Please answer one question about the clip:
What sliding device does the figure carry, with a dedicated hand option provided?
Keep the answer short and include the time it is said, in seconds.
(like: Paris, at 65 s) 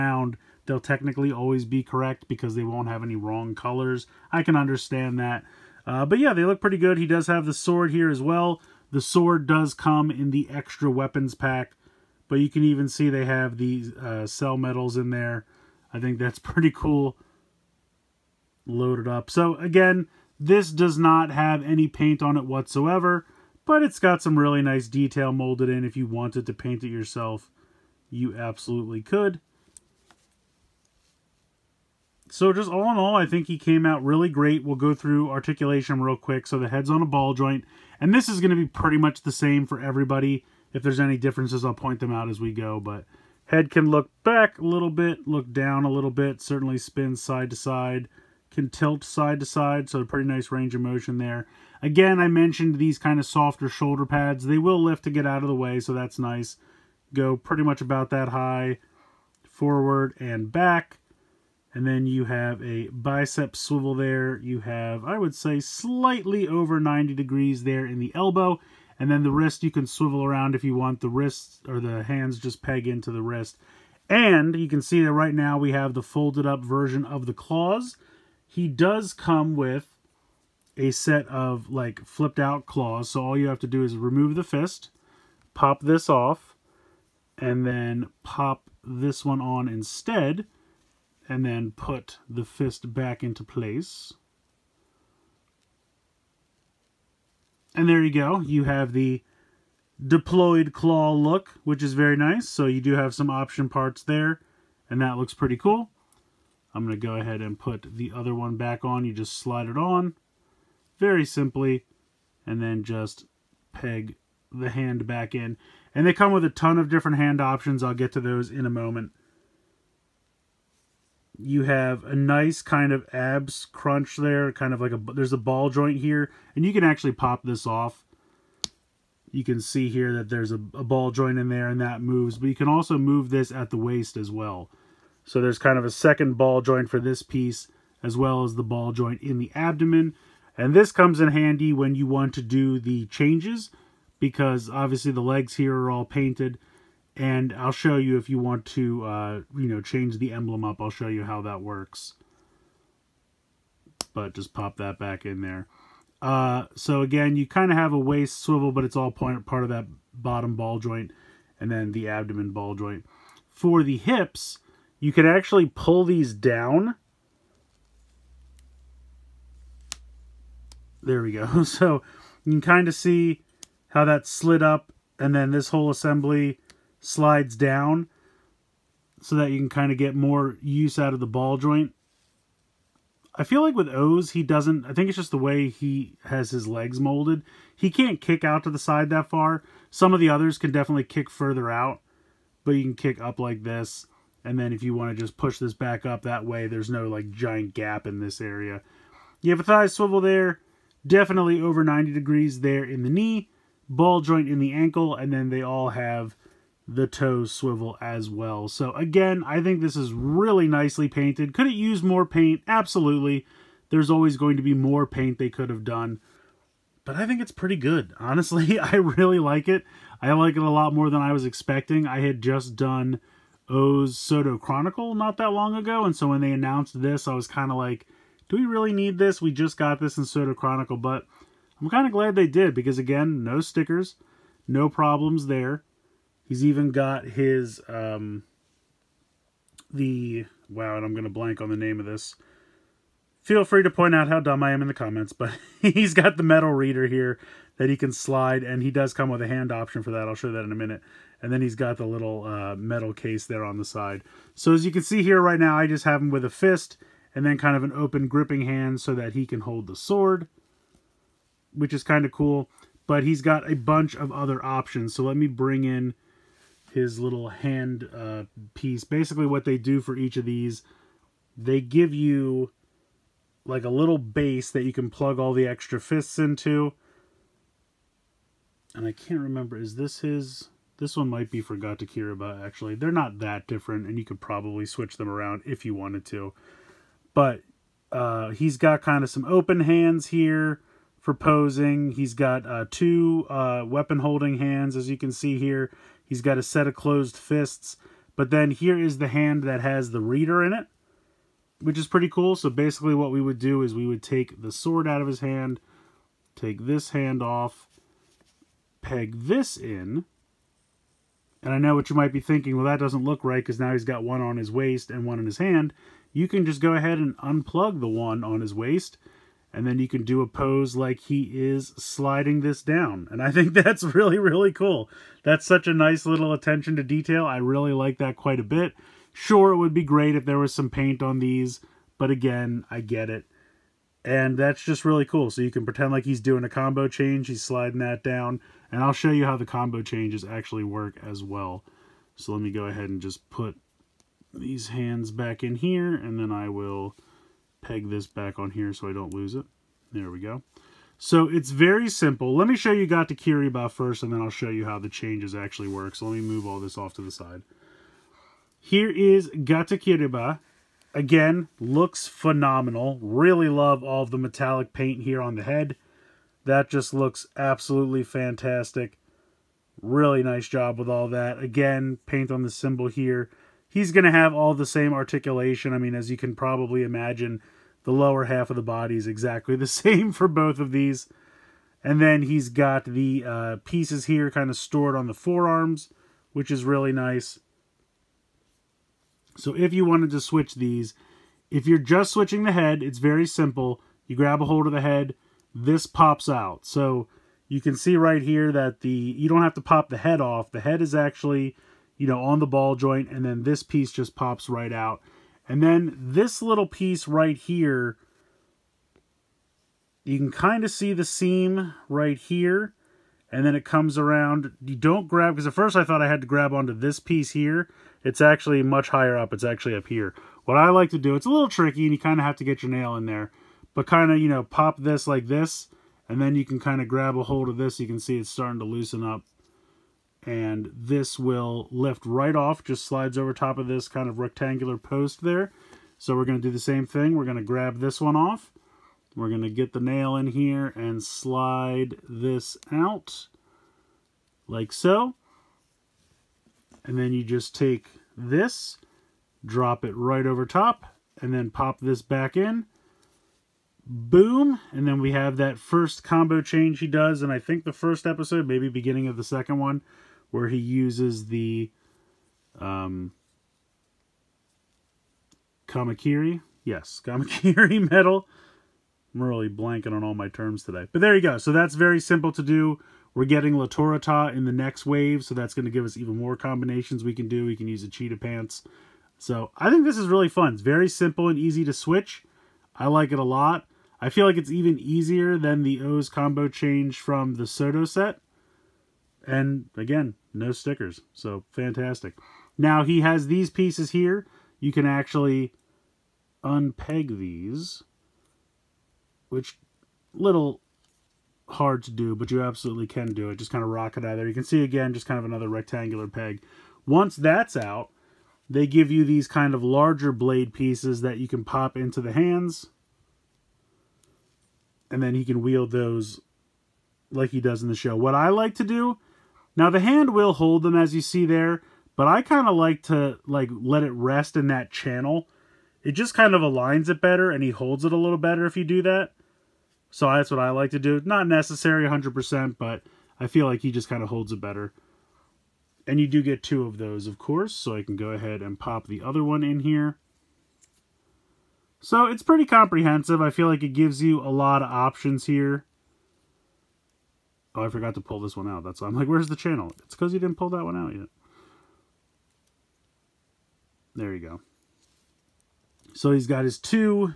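metal reader, at 246 s.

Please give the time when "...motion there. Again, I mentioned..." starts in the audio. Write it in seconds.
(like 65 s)
50 s.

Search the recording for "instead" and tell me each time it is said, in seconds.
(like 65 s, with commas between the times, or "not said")
89 s.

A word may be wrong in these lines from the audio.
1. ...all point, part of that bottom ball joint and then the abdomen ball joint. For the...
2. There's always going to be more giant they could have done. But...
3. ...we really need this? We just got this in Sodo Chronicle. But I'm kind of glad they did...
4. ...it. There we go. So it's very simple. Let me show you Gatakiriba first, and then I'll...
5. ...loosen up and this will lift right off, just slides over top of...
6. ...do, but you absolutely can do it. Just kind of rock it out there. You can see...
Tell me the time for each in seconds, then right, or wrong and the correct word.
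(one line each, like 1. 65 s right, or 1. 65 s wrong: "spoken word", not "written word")
1. 158 s right
2. 213 s wrong: "paint", not "giant"
3. 228 s right
4. 349 s right
5. 428 s right
6. 502 s right.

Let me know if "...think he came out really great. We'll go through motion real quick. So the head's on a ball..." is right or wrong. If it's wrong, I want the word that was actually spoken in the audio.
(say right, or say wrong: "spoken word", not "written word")
wrong: "articulation", not "motion".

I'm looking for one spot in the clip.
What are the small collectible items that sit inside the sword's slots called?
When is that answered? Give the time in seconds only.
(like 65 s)
14 s.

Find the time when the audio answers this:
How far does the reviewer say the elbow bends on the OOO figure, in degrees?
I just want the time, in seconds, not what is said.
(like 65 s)
65 s.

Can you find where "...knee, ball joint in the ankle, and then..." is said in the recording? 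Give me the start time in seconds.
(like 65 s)
203 s.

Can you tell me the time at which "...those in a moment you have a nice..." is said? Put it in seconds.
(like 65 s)
118 s.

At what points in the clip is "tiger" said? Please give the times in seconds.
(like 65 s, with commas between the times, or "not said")
not said.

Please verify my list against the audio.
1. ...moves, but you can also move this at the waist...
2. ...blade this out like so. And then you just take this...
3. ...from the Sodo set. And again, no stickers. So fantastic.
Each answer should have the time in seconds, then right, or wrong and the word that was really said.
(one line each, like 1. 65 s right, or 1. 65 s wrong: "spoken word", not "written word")
1. 132 s right
2. 441 s wrong: "slide", not "blade"
3. 487 s right.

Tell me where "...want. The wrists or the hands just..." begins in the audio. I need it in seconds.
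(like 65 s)
70 s.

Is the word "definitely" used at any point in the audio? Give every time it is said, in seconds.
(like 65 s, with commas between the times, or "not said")
190 s, 201 s.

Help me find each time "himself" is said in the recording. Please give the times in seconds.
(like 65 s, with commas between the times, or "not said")
not said.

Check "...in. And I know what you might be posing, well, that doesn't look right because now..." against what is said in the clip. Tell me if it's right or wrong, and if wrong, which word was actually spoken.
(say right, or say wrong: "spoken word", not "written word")
wrong: "thinking", not "posing".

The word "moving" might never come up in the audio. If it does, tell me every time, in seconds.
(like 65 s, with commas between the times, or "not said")
not said.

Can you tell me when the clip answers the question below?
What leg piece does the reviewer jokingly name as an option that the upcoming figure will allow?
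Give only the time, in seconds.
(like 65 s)
478 s.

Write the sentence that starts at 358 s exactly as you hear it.
Here is Gata Again, looks phenomenal.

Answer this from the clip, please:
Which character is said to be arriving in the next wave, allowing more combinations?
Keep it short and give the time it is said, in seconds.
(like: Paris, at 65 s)
Latorata, at 473 s.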